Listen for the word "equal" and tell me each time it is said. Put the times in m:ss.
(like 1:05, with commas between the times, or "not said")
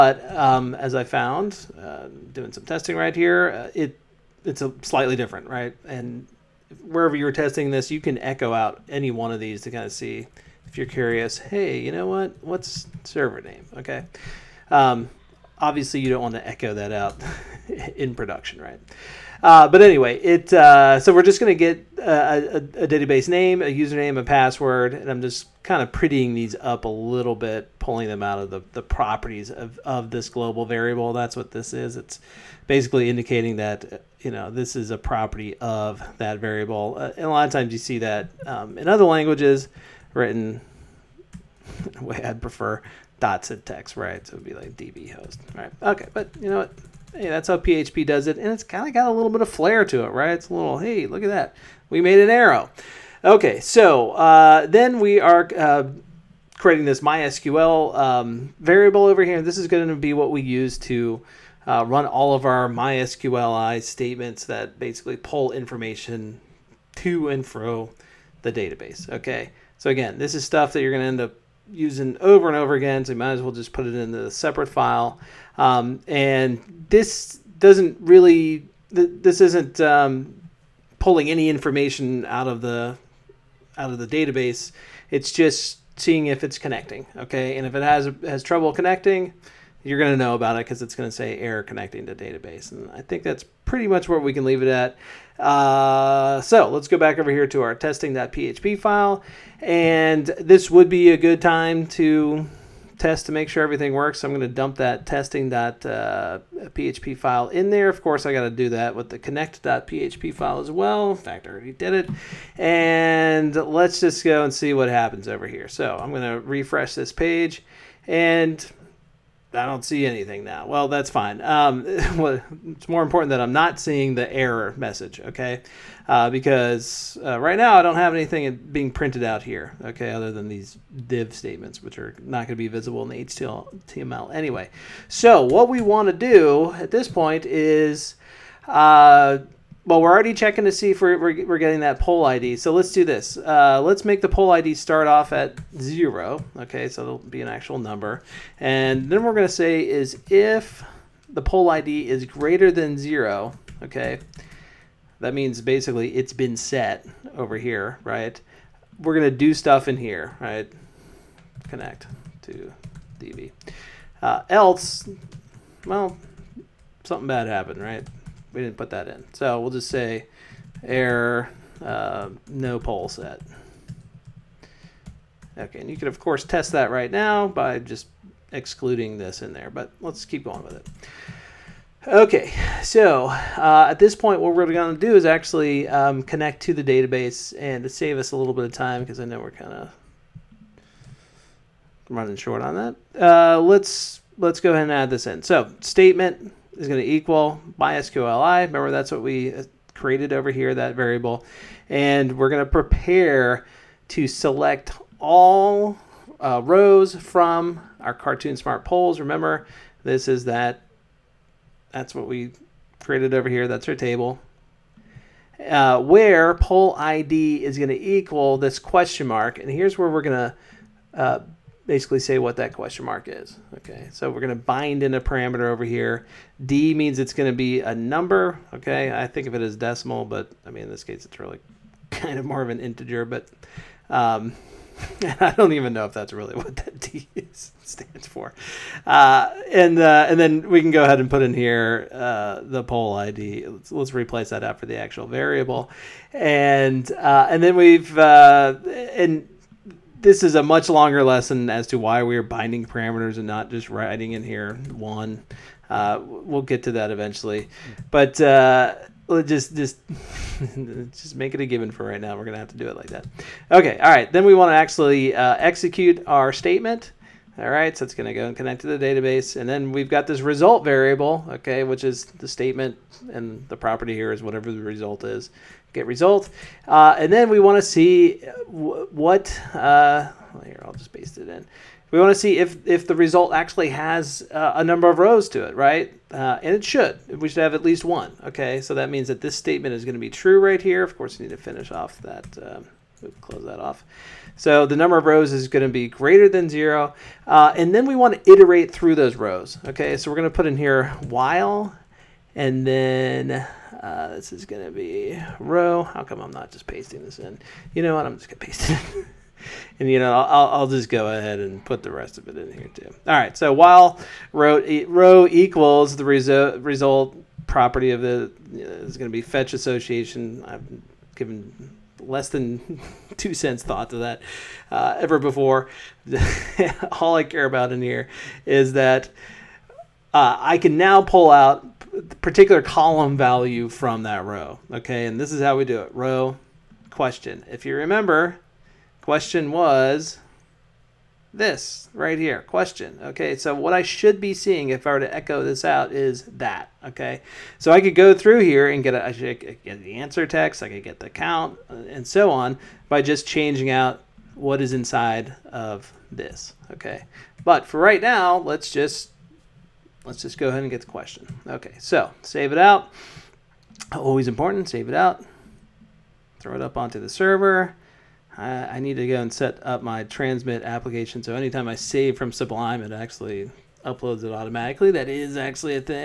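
3:17, 3:38, 5:15.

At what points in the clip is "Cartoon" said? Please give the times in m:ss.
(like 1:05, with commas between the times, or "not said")
3:28.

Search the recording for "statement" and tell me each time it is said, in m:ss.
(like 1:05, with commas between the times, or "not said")
1:03, 2:11, 3:15, 4:26, 4:32, 4:49.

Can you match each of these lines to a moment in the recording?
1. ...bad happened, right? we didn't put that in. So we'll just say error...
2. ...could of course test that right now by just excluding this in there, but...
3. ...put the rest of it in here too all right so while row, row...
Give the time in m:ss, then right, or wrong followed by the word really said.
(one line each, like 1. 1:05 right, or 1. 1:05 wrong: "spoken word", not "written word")
1. 2:47 right
2. 2:55 right
3. 5:11 right.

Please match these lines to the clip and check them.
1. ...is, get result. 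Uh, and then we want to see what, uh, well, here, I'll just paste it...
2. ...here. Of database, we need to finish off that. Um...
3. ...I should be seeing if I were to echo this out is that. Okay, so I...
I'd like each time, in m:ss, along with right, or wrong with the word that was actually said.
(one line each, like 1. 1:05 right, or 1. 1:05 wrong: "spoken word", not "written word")
1. 4:35 right
2. 4:50 wrong: "course", not "database"
3. 5:43 right.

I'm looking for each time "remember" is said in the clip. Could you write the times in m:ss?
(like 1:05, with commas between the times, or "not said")
3:18, 3:29, 5:37.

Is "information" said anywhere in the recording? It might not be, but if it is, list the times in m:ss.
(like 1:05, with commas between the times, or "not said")
1:05, 1:21.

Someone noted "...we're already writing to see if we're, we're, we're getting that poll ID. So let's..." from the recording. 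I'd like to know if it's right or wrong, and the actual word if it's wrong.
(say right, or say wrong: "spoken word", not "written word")
wrong: "checking", not "writing".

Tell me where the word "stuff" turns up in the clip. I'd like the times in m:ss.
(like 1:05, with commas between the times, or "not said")
1:10, 2:39.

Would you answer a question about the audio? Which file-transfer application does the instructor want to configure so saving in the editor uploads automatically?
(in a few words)
Transmit.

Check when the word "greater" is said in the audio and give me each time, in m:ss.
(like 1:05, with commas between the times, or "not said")
2:32, 4:56.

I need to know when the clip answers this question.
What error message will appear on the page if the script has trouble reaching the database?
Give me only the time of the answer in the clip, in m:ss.
1:31.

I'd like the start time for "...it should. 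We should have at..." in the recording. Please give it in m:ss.
4:46.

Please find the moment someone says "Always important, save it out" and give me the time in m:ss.
6:04.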